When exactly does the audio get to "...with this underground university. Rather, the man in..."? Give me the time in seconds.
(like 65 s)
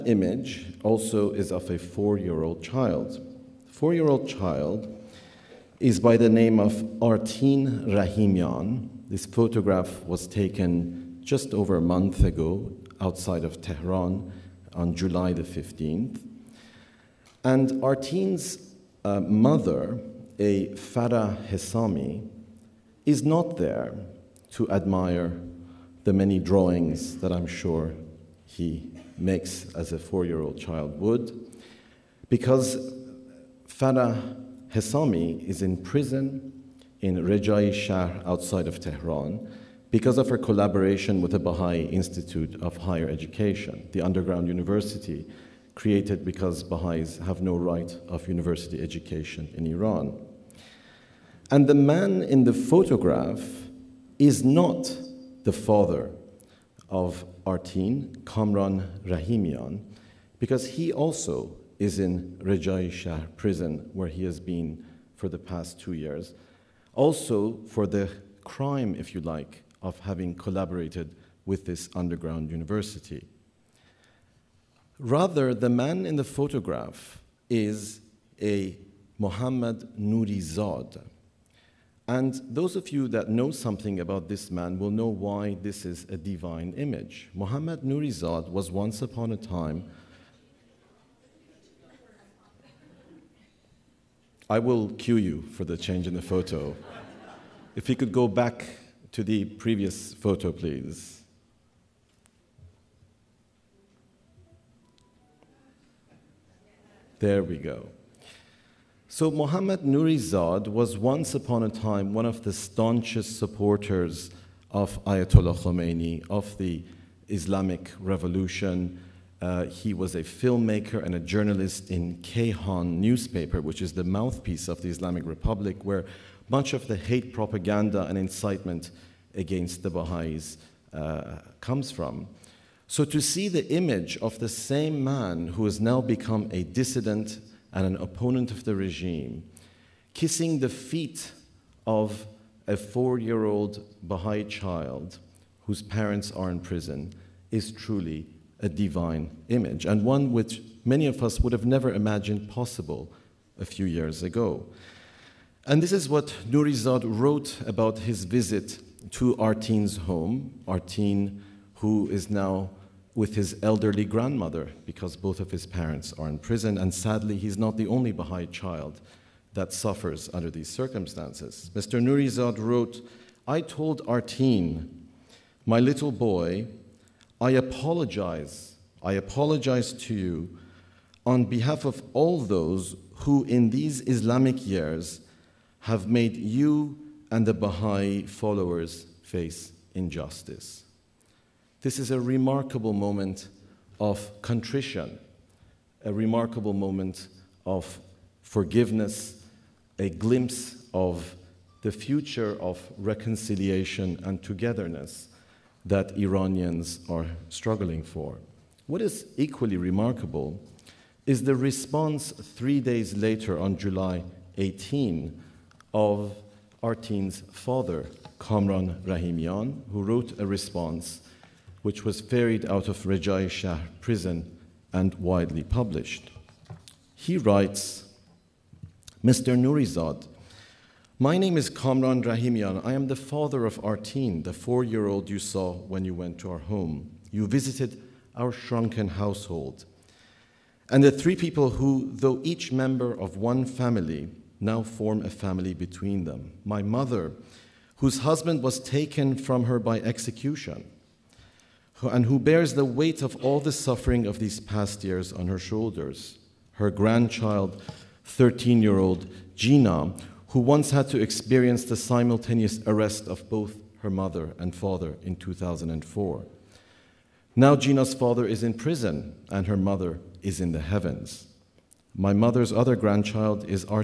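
71 s.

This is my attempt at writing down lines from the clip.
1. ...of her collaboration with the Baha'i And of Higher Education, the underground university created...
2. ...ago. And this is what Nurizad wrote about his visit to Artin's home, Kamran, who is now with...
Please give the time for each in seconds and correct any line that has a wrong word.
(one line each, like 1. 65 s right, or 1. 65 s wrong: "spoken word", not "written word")
1. 40 s wrong: "Institute", not "And"
2. 154 s wrong: "Artin", not "Kamran".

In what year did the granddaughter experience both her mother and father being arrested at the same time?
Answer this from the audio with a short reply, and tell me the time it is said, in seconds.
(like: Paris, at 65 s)
2004, at 265 s.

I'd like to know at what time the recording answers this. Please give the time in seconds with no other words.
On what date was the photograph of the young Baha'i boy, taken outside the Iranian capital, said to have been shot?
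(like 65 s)
14 s.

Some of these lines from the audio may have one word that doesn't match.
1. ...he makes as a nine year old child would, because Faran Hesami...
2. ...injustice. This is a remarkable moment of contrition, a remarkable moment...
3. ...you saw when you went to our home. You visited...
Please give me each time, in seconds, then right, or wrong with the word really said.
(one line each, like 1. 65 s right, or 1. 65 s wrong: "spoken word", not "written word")
1. 28 s wrong: "four", not "nine"
2. 189 s right
3. 235 s right.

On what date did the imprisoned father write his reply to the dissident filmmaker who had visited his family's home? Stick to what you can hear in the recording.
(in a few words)
July 18.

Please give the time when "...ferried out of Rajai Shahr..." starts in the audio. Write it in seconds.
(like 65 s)
222 s.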